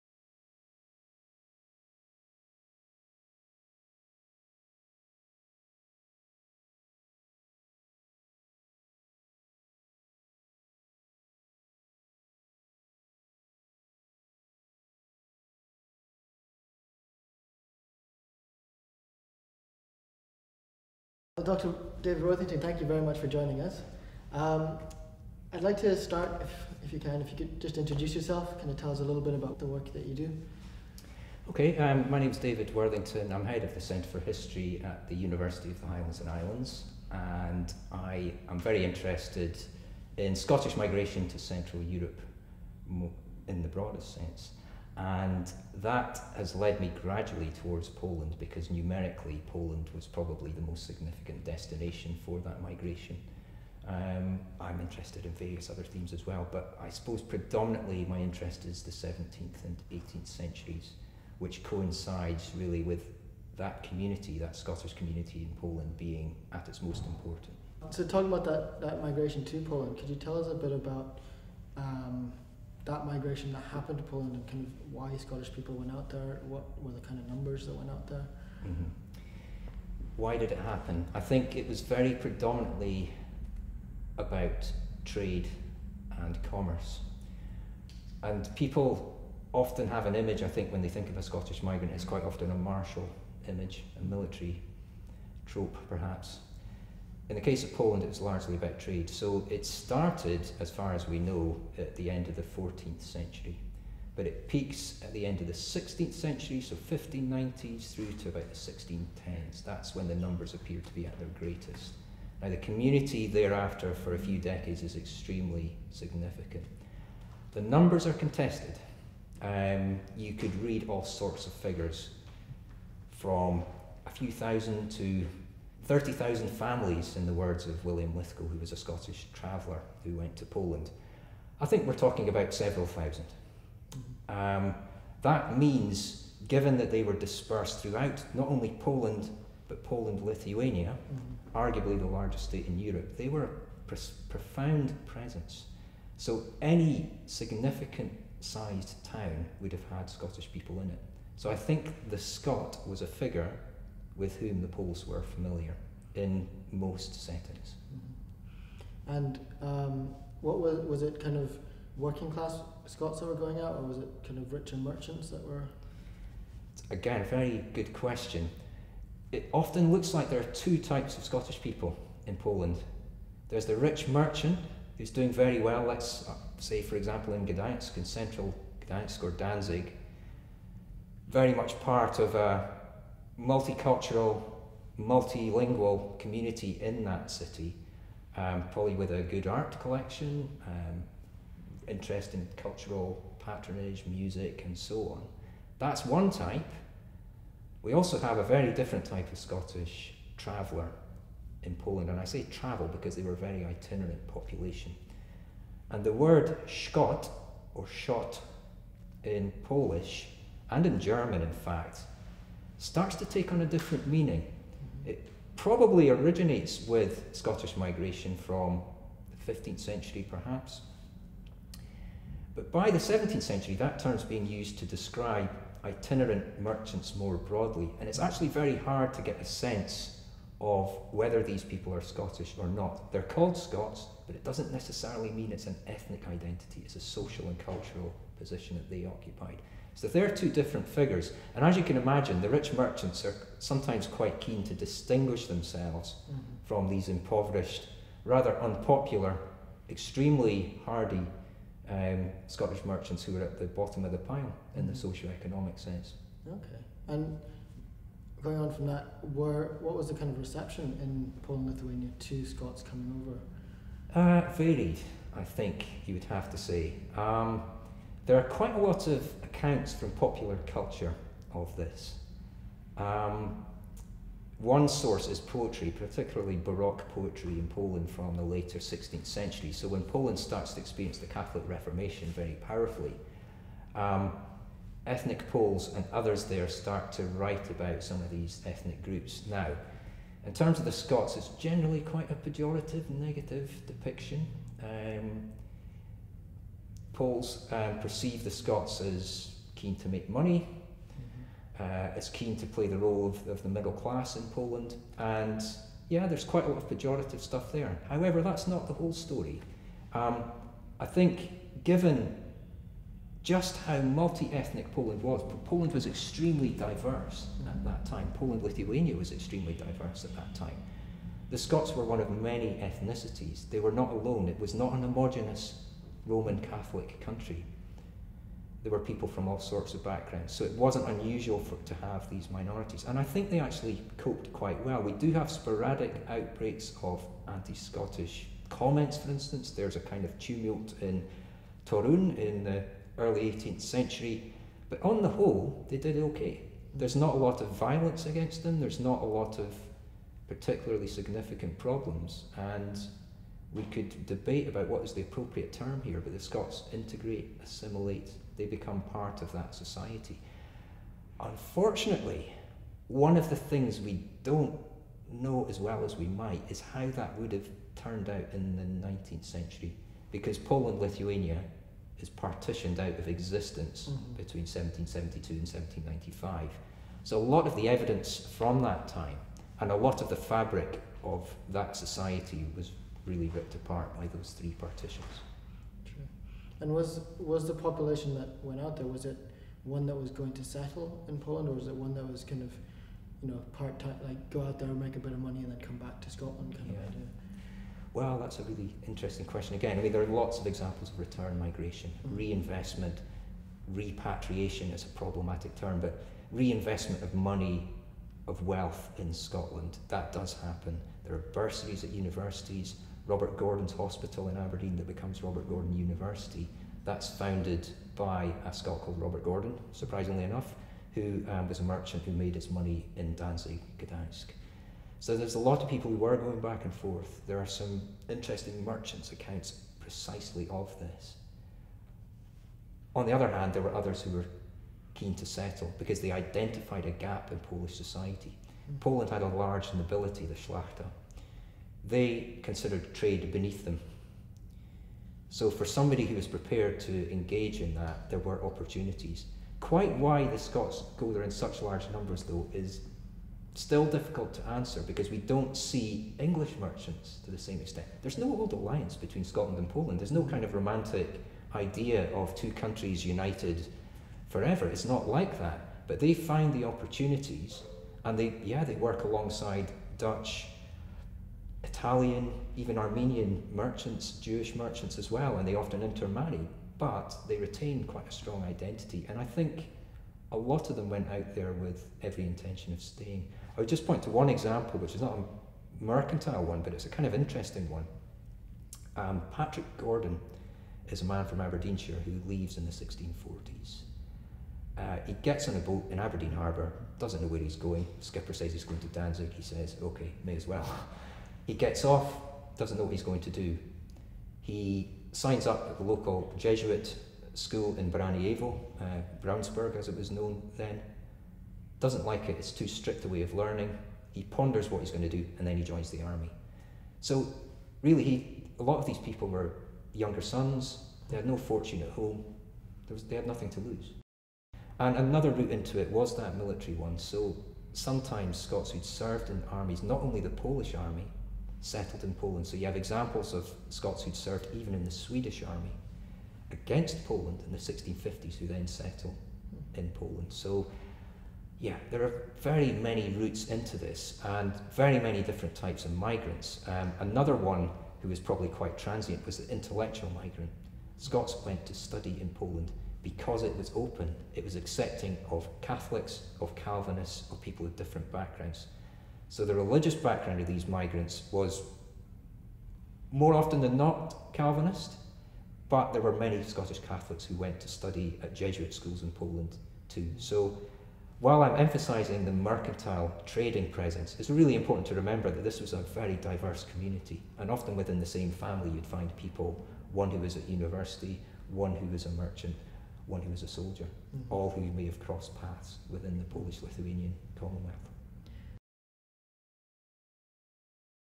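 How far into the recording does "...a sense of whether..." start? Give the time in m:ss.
3:49.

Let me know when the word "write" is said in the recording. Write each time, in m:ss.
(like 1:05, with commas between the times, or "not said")
4:47.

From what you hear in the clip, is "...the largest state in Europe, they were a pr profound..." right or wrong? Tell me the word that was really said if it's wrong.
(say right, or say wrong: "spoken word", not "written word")
right.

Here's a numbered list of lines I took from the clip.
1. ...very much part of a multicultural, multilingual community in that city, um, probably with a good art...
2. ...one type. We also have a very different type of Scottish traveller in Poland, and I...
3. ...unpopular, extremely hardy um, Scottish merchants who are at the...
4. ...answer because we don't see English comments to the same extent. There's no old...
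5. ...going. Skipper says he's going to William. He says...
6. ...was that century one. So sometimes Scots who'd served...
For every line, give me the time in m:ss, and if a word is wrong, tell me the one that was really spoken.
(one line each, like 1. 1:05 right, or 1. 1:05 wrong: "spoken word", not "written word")
1. 3:01 right
2. 3:16 right
3. 4:08 right
4. 7:34 wrong: "merchants", not "comments"
5. 8:17 wrong: "Danzig", not "William"
6. 8:46 wrong: "military", not "century".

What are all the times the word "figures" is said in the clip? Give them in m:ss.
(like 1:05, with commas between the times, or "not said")
2:01, 2:33, 4:00.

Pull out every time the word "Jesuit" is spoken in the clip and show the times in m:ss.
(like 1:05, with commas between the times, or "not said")
8:26, 9:28.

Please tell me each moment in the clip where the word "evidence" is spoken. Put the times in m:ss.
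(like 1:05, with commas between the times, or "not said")
6:17.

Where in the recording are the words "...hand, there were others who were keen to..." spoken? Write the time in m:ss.
7:13.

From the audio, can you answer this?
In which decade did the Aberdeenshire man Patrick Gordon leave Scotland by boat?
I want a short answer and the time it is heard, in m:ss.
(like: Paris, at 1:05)
1640s, at 8:12.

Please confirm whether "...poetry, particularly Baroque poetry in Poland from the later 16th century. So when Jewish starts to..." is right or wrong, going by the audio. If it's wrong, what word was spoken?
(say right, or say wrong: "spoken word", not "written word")
wrong: "Poland", not "Jewish".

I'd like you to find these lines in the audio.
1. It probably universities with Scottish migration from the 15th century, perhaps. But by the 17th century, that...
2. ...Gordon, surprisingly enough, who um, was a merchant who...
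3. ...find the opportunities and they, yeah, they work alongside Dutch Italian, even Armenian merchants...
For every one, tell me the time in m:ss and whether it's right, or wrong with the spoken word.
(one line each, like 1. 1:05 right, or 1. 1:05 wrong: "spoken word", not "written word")
1. 3:35 wrong: "originates", not "universities"
2. 6:59 right
3. 7:46 right.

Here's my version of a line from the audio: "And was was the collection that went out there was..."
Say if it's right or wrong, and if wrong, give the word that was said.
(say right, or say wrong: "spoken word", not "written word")
wrong: "population", not "collection".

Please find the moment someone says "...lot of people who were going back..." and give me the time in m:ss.
7:05.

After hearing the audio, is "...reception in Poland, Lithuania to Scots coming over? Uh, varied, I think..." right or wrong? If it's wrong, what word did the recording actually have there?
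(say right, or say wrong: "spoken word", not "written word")
right.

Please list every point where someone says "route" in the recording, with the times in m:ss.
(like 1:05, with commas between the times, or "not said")
8:45, 9:03.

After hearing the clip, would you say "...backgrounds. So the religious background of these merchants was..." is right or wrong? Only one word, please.
wrong.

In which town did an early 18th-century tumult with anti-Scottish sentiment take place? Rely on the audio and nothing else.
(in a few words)
Torun.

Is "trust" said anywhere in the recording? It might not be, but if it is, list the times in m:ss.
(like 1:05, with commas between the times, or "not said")
not said.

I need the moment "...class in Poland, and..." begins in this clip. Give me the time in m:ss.
5:03.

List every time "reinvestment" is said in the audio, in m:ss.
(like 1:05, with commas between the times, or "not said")
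6:42, 6:46.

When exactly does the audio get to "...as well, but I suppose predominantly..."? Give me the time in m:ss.
0:56.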